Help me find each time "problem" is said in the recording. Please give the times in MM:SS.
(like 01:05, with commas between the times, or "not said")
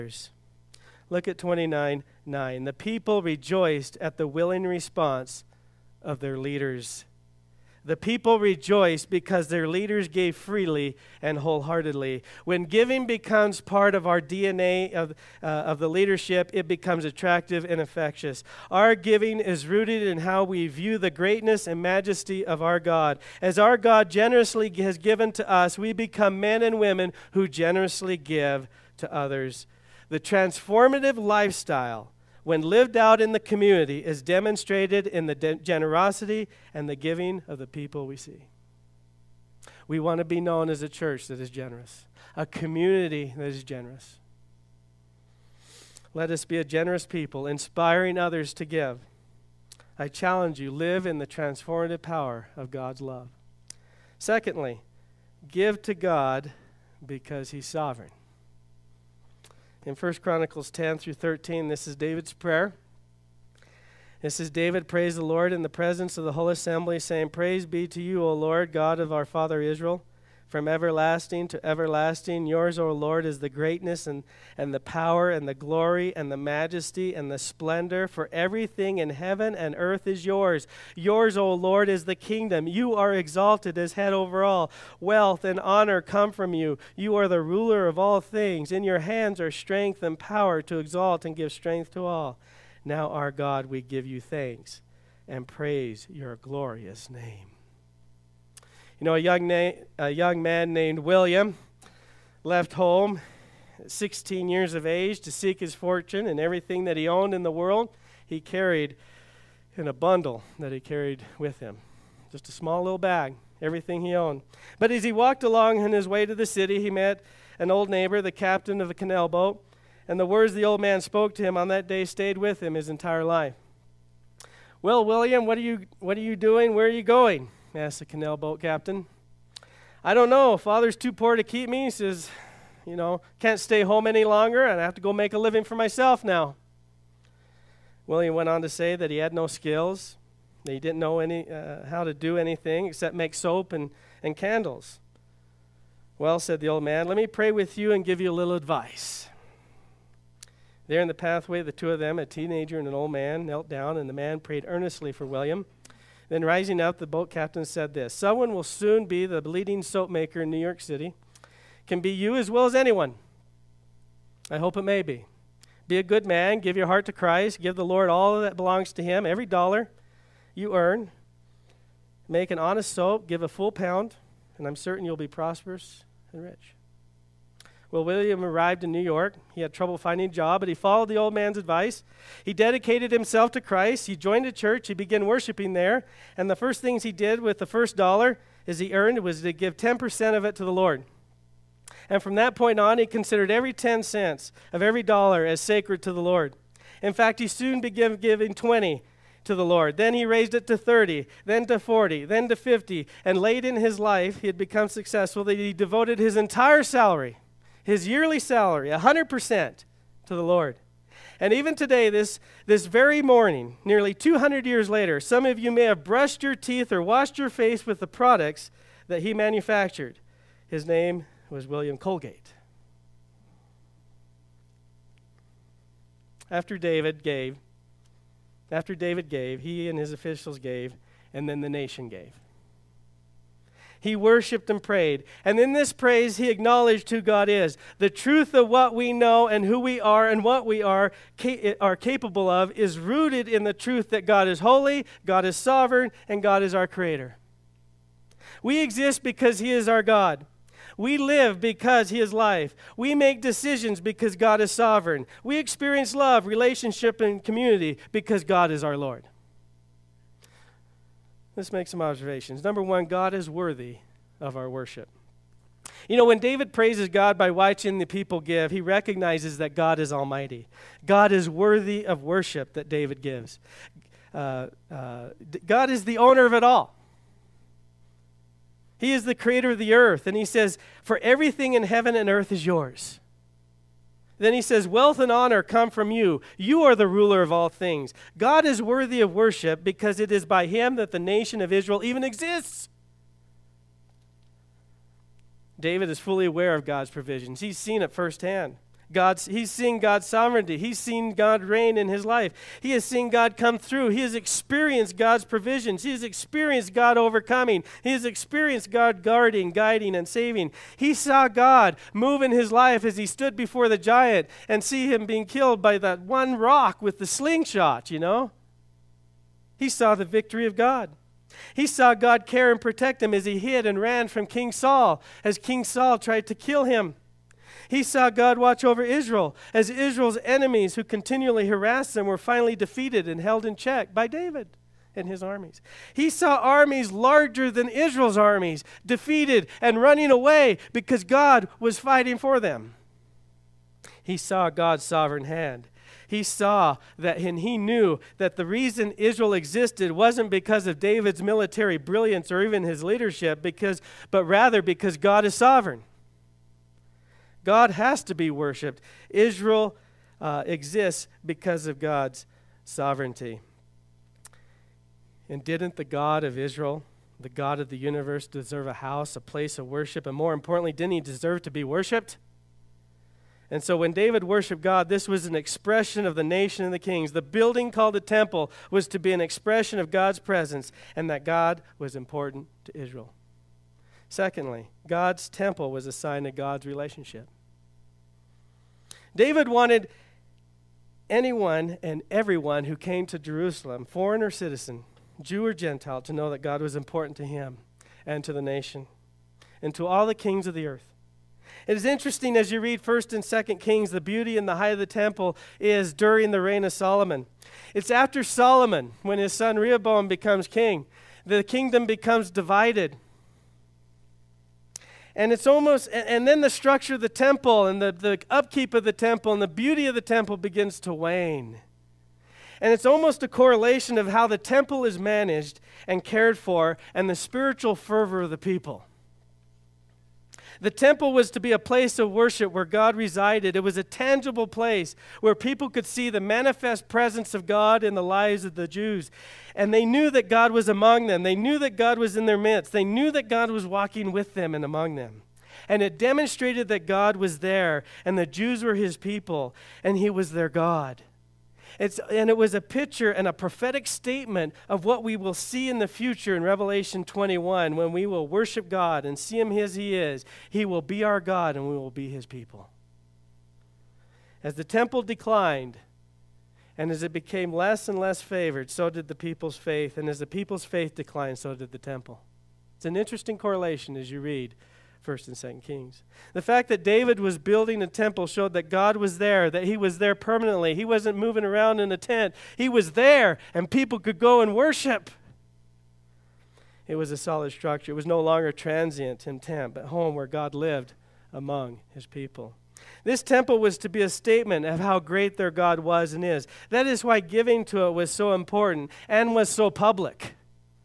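not said.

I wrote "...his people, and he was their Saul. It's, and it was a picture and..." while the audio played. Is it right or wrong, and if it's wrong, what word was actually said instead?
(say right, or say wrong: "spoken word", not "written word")
wrong: "God", not "Saul".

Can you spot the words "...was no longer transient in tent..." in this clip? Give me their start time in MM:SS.
08:08.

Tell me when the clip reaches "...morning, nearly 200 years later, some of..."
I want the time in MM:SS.
03:33.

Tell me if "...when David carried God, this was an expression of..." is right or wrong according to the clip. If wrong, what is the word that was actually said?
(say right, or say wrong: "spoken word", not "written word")
wrong: "worshiped", not "carried".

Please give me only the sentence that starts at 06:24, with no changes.
Secondly, God's temple was a sign of God's relationship.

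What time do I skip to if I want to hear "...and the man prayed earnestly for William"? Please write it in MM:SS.
02:33.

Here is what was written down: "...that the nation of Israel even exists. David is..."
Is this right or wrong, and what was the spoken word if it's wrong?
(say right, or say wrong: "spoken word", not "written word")
right.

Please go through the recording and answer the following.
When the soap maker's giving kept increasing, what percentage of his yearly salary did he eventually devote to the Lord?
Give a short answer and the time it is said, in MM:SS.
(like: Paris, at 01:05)
100%, at 03:28.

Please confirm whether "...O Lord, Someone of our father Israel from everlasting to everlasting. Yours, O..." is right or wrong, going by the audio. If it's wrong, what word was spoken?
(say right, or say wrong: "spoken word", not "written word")
wrong: "God", not "Someone".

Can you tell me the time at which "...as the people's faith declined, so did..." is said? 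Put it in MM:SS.
07:50.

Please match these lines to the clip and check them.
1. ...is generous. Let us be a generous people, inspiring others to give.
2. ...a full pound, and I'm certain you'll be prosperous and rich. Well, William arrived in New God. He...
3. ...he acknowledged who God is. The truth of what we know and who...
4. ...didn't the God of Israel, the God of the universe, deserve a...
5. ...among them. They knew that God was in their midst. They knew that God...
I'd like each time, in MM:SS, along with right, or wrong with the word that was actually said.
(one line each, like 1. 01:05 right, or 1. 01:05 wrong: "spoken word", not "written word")
1. 00:43 right
2. 02:53 wrong: "York", not "God"
3. 03:56 right
4. 06:05 right
5. 07:20 right.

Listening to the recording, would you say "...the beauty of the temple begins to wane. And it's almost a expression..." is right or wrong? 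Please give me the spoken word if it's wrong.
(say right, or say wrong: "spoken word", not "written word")
wrong: "correlation", not "expression".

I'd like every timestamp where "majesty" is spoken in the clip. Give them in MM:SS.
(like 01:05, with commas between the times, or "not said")
00:21, 01:16.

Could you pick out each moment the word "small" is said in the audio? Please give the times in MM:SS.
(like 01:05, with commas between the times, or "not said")
01:52.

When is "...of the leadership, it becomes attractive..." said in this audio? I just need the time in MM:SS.
00:15.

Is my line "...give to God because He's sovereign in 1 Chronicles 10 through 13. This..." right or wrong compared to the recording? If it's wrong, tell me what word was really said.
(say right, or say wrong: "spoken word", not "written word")
right.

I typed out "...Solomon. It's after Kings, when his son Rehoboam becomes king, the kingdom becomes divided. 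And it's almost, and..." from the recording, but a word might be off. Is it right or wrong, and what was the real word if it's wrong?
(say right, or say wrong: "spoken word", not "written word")
wrong: "Solomon", not "Kings".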